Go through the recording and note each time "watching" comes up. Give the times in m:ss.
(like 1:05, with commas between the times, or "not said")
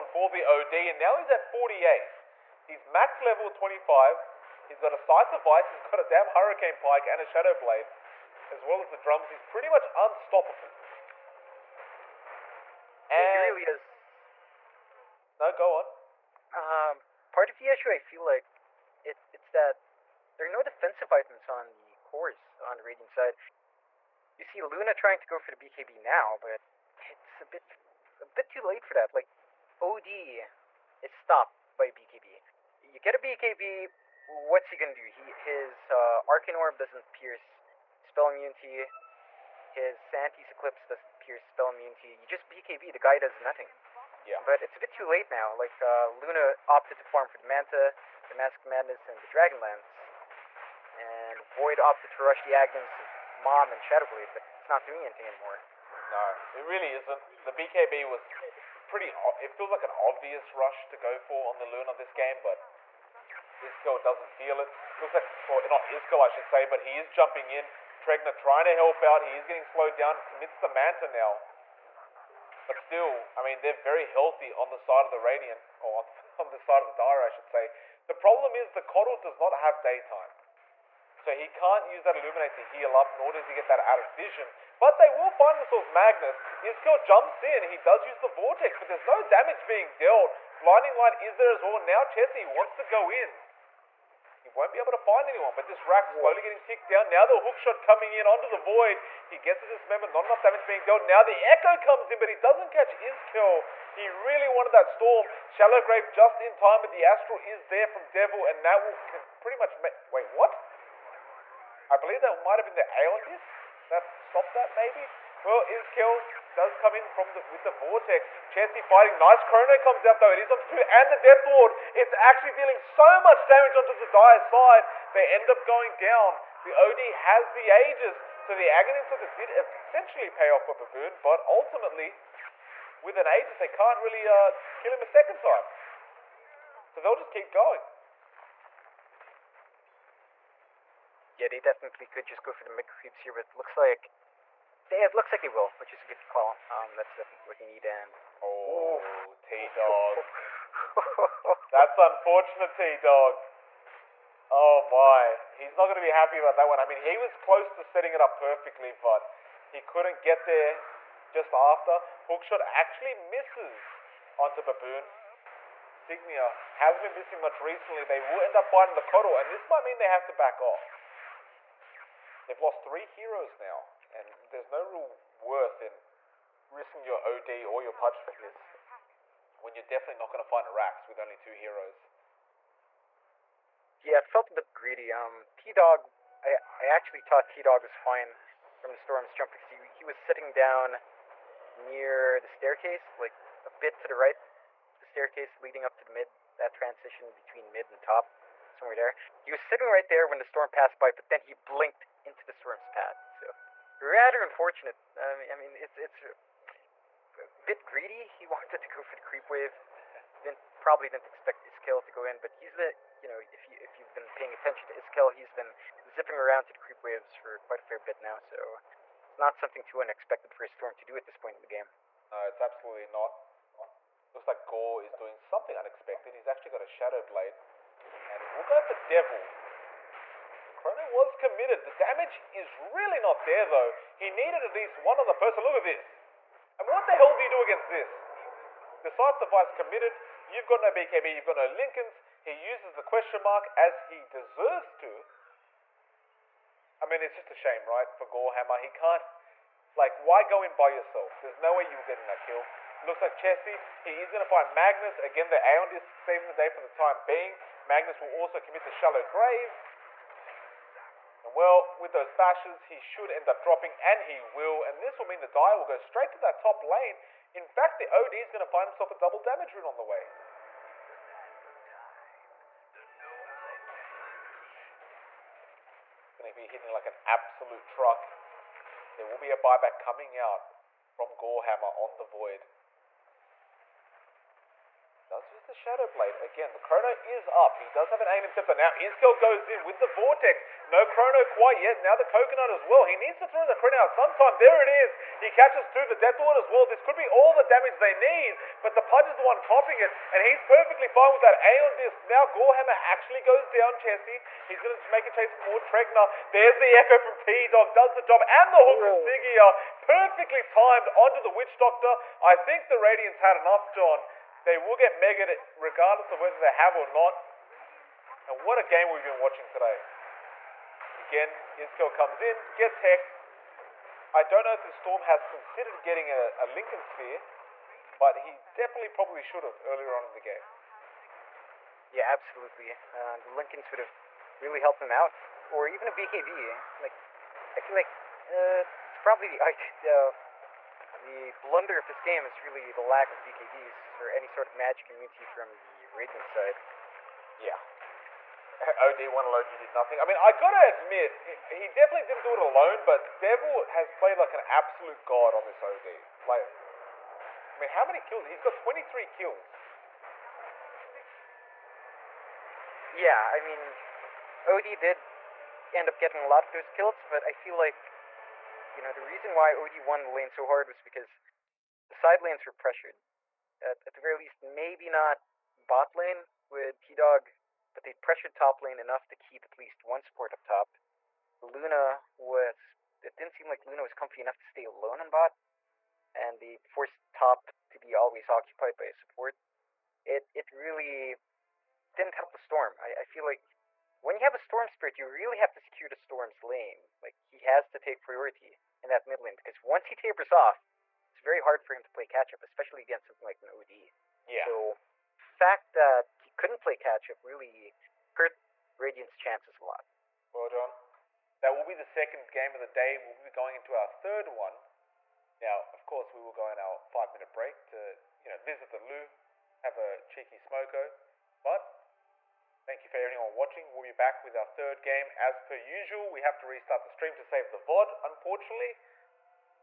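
5:19, 7:03.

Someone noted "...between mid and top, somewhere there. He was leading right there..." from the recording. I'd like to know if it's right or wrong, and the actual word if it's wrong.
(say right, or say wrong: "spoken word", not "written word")
wrong: "sitting", not "leading".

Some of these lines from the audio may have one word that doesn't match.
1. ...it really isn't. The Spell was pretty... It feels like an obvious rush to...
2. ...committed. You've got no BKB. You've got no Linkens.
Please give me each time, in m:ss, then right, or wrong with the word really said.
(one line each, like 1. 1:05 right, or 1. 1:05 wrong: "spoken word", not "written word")
1. 0:56 wrong: "BKB", not "Spell"
2. 3:59 right.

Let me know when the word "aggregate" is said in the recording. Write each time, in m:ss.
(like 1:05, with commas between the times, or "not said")
not said.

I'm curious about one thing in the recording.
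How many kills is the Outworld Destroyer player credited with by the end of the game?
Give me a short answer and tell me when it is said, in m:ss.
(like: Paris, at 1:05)
23, at 5:58.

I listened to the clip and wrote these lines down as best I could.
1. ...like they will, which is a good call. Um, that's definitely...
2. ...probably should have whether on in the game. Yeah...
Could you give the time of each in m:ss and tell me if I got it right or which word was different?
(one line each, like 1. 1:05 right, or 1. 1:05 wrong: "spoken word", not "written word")
1. 2:25 right
2. 5:29 wrong: "earlier", not "whether".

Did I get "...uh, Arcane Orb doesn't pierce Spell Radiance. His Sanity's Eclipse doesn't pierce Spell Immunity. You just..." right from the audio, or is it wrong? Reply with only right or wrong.
wrong.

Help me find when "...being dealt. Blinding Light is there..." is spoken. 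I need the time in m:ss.
1:29.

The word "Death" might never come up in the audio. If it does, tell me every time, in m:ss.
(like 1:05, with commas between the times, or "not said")
2:01, 4:56.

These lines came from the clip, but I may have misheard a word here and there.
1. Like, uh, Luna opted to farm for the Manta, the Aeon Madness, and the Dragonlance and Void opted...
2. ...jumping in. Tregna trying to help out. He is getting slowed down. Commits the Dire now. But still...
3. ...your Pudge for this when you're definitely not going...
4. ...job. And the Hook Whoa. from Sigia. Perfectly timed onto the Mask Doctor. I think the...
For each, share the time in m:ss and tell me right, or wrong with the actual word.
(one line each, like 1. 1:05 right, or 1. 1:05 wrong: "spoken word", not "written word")
1. 0:45 wrong: "Mask", not "Aeon"
2. 1:07 wrong: "Manta", not "Dire"
3. 2:57 right
4. 5:08 wrong: "Witch", not "Mask".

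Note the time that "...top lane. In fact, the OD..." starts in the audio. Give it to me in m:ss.
4:26.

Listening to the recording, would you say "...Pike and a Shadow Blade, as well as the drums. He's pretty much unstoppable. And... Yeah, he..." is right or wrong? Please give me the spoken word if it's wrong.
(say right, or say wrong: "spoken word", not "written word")
right.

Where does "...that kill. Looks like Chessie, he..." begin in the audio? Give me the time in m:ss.
4:12.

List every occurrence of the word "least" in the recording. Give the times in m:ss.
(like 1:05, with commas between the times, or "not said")
3:54, 6:14, 6:19.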